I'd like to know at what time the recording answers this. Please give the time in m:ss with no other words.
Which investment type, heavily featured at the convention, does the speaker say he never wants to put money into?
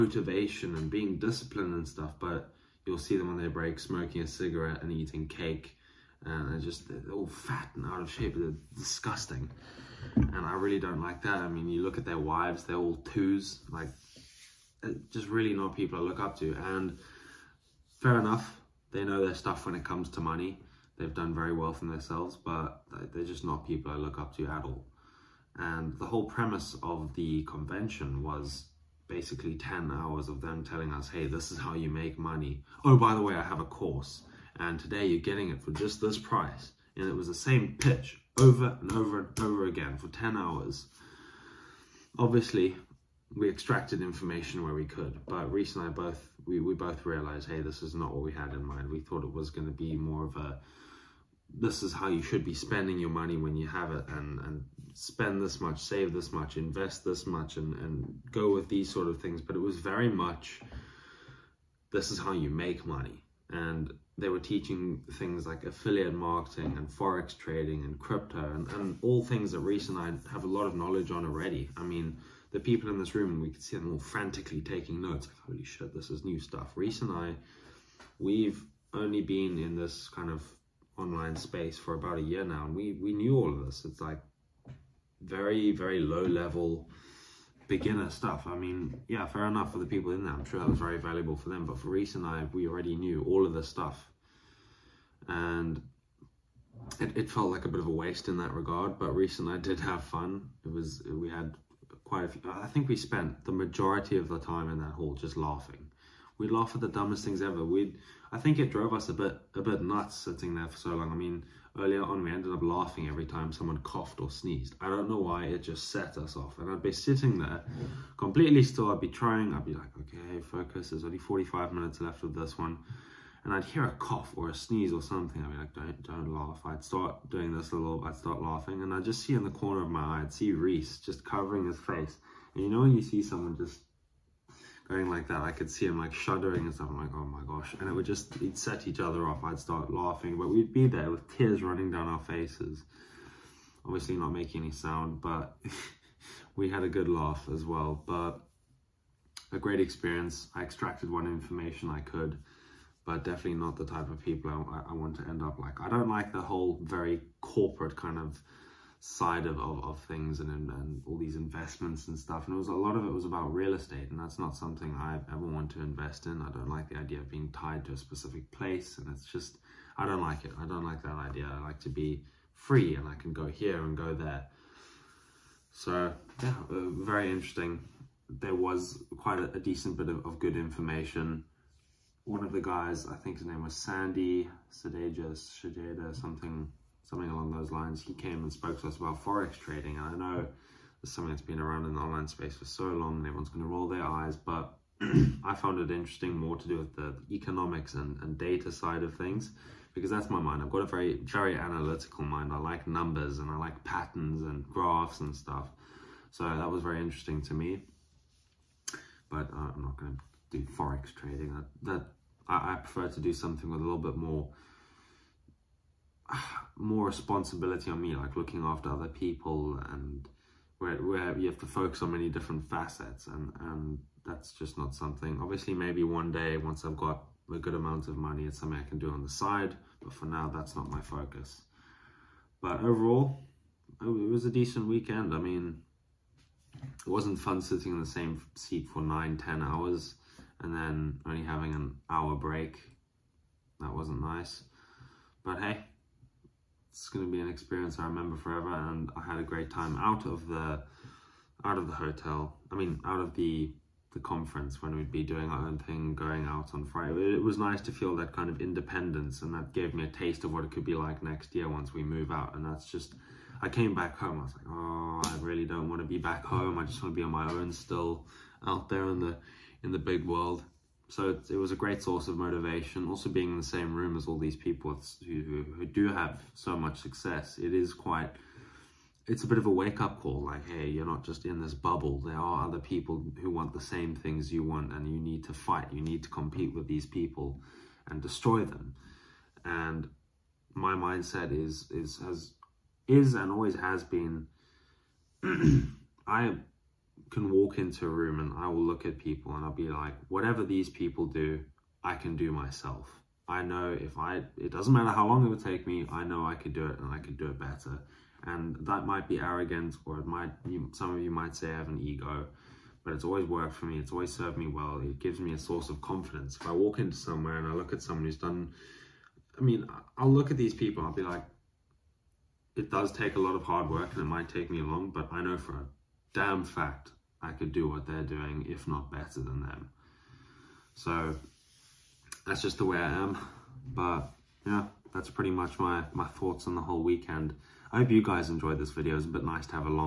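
2:43.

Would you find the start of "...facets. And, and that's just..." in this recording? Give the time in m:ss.
3:42.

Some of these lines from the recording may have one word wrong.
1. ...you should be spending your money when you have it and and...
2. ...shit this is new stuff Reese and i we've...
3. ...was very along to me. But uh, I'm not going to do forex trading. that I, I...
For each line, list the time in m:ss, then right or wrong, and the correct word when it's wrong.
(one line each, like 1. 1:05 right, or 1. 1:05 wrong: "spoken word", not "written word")
1. 0:52 right
2. 1:15 right
3. 3:26 wrong: "interesting", not "along".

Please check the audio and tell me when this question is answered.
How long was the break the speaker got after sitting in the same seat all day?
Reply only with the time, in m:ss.
4:01.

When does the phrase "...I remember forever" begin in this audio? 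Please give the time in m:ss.
4:07.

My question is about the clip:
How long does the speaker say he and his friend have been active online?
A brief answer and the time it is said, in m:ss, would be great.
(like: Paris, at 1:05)
about a year, at 1:21.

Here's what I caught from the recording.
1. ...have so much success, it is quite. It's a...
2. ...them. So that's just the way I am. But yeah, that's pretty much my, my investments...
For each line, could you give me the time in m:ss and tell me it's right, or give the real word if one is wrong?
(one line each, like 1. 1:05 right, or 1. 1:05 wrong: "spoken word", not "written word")
1. 4:36 right
2. 5:29 wrong: "thoughts", not "investments".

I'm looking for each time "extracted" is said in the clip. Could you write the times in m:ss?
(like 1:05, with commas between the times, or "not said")
0:43, 2:30.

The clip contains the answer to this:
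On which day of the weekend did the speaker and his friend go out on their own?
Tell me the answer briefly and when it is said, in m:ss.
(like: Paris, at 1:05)
Friday, at 4:16.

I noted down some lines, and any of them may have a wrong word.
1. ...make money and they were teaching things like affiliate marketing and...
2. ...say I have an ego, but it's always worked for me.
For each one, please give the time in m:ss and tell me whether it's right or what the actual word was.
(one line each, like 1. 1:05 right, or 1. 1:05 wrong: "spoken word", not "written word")
1. 1:02 right
2. 5:11 right.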